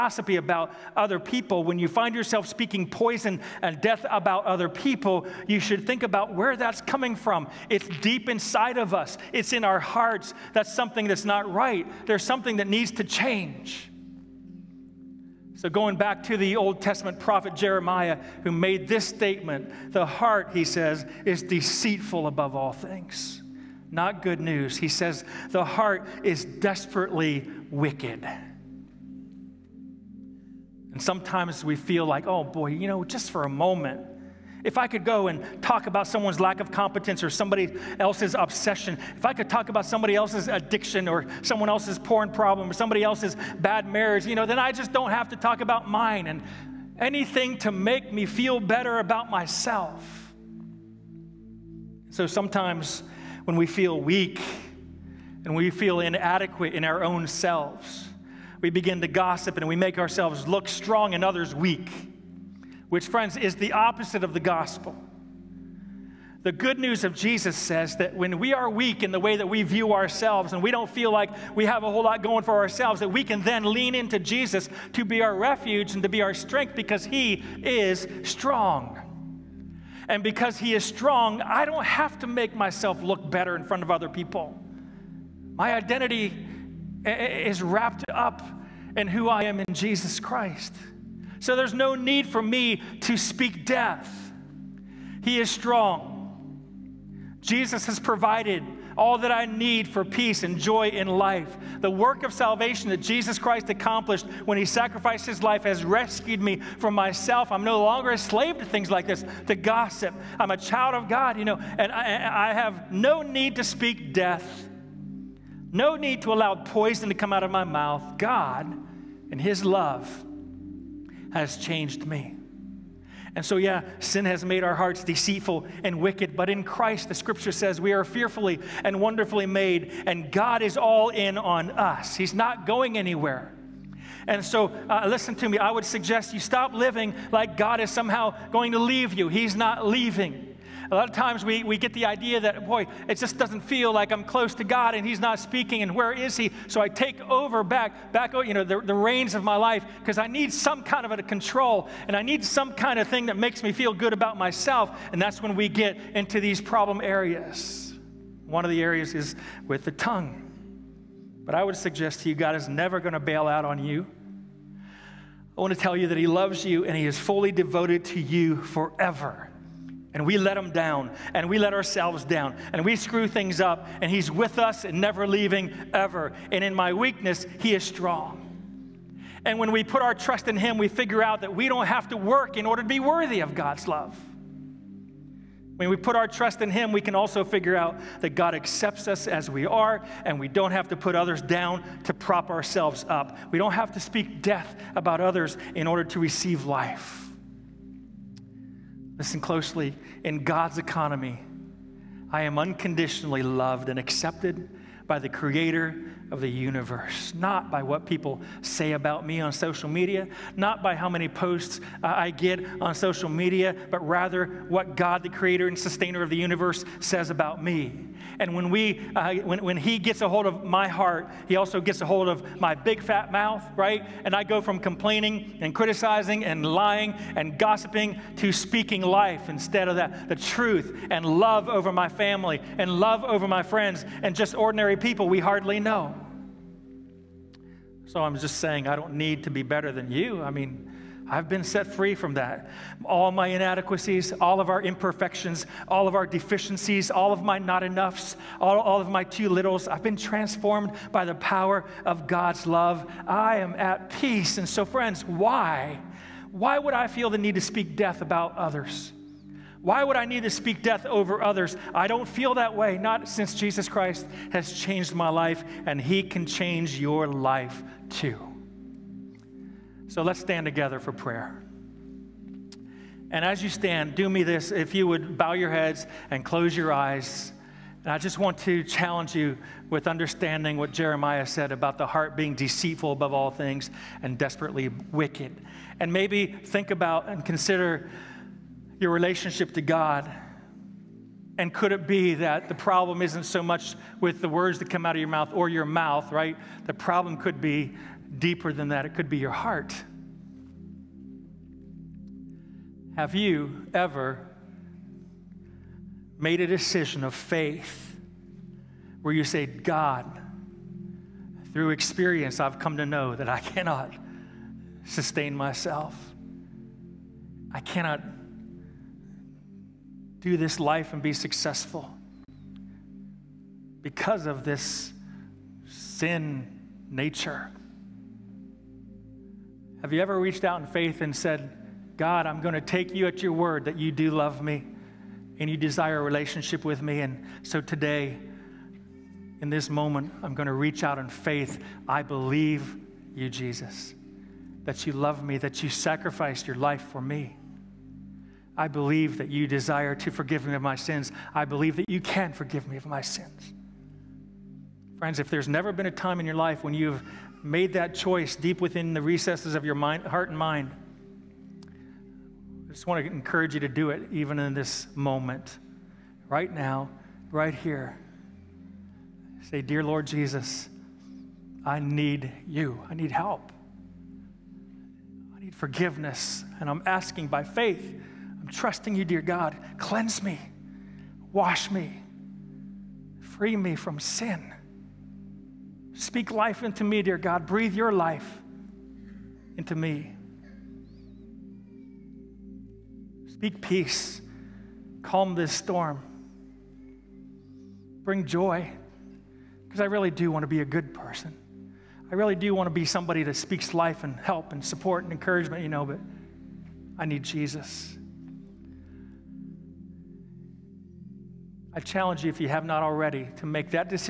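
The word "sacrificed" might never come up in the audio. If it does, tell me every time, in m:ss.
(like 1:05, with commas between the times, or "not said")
1:44, 5:45.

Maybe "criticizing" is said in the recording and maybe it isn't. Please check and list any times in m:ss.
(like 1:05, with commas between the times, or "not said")
3:45.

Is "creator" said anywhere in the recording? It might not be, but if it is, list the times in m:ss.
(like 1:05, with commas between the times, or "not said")
3:25, 3:35.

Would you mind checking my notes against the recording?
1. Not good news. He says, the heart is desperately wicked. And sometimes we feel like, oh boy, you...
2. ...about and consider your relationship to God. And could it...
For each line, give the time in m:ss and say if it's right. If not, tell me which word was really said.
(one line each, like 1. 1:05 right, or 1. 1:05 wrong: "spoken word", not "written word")
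1. 0:23 right
2. 4:46 right.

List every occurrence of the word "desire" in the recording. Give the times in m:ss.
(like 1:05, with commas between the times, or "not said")
5:35, 5:49.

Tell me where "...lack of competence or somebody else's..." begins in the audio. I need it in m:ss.
0:36.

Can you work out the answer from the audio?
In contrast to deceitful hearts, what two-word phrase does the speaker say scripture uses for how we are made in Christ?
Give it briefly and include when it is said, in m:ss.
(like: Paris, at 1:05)
fearfully and wonderfully, at 2:08.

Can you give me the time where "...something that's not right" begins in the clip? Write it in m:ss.
0:10.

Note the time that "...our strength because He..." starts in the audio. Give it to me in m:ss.
1:16.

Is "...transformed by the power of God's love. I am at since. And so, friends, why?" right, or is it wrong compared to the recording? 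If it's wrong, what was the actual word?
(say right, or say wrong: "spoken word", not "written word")
wrong: "peace", not "since".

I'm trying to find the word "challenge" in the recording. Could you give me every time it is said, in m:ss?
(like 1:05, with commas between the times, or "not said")
4:38, 6:51.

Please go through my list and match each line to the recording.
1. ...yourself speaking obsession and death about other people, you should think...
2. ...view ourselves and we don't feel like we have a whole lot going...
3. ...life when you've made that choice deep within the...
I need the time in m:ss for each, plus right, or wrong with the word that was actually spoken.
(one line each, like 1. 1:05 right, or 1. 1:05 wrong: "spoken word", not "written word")
1. 0:02 wrong: "poison", not "obsession"
2. 1:09 right
3. 5:56 right.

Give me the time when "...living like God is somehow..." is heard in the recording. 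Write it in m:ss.
2:16.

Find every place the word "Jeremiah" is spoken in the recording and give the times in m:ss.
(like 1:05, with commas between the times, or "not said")
0:17, 4:40.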